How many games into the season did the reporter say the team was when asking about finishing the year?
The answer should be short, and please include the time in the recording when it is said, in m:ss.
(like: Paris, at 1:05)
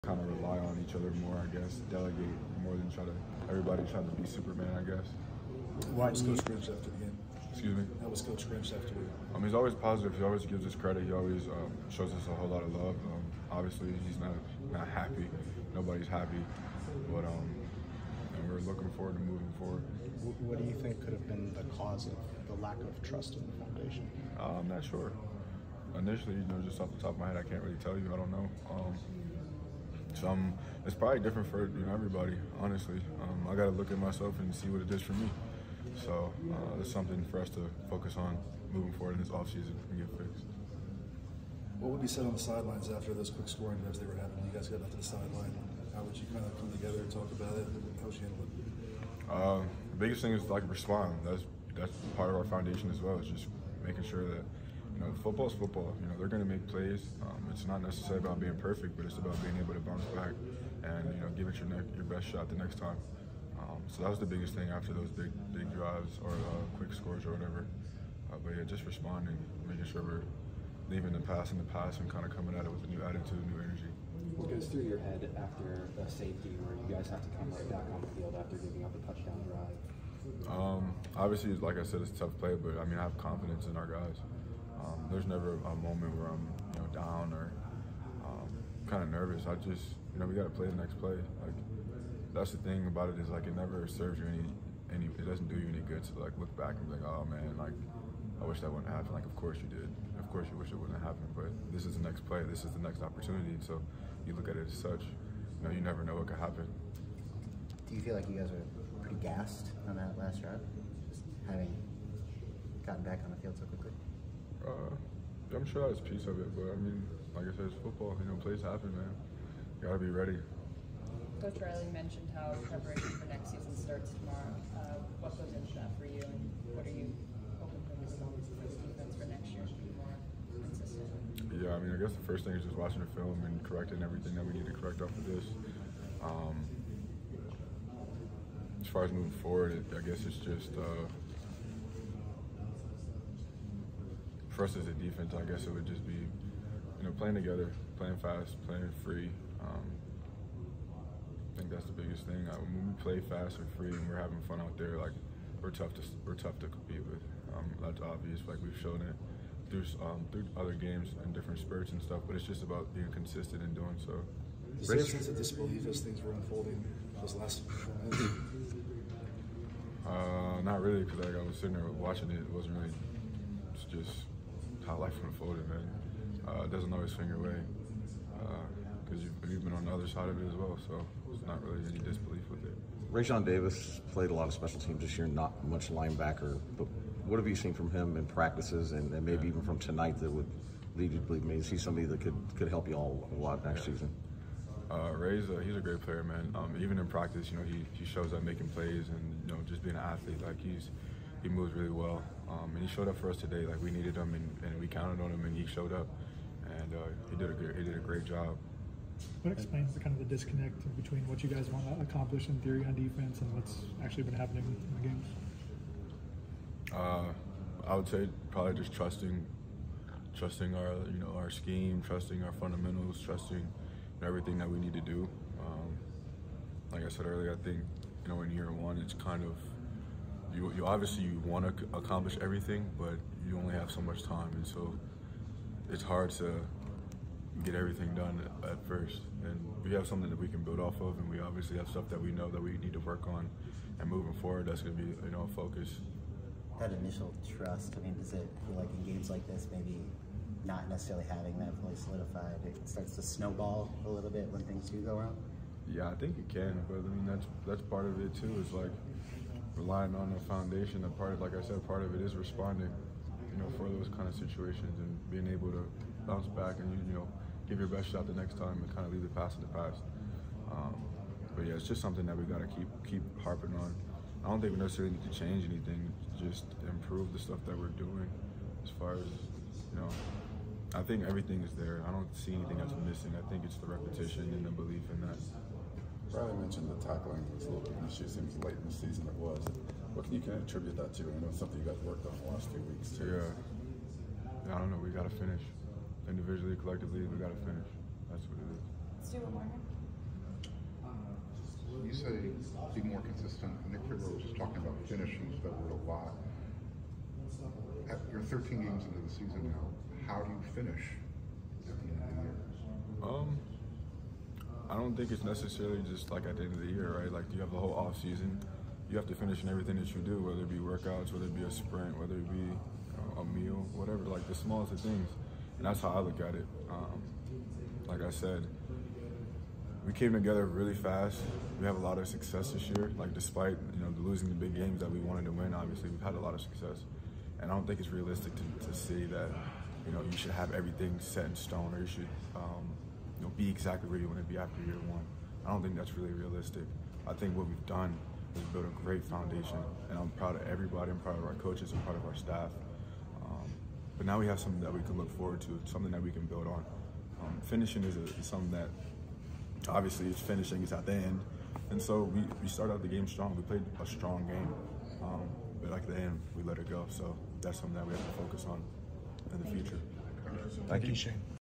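13, at 5:08.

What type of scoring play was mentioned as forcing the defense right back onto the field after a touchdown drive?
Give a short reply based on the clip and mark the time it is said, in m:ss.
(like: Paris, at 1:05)
Safety, at 1:16.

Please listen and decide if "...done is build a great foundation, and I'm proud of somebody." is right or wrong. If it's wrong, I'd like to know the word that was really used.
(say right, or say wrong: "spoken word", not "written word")
wrong: "everybody", not "somebody".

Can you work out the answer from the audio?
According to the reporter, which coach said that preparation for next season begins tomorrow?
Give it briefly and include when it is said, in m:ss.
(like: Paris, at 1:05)
Coach Riley, at 2:01.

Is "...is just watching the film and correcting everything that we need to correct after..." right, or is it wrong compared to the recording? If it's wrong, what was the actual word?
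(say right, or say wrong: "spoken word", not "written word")
right.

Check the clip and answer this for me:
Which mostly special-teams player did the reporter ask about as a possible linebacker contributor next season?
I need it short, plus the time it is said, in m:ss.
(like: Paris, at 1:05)
Raesjon Davis, at 3:03.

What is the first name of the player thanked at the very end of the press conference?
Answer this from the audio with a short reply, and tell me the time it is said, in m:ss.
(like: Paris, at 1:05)
Shane, at 6:11.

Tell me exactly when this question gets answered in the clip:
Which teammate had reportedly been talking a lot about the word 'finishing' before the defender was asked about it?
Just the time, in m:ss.
5:03.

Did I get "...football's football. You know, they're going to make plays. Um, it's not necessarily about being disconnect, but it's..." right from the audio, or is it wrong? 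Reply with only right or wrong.
wrong.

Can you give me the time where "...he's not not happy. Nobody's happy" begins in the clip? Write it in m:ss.
0:14.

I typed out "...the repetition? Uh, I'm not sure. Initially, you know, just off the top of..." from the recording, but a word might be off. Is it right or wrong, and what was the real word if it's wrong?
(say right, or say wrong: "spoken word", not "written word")
wrong: "foundation", not "repetition".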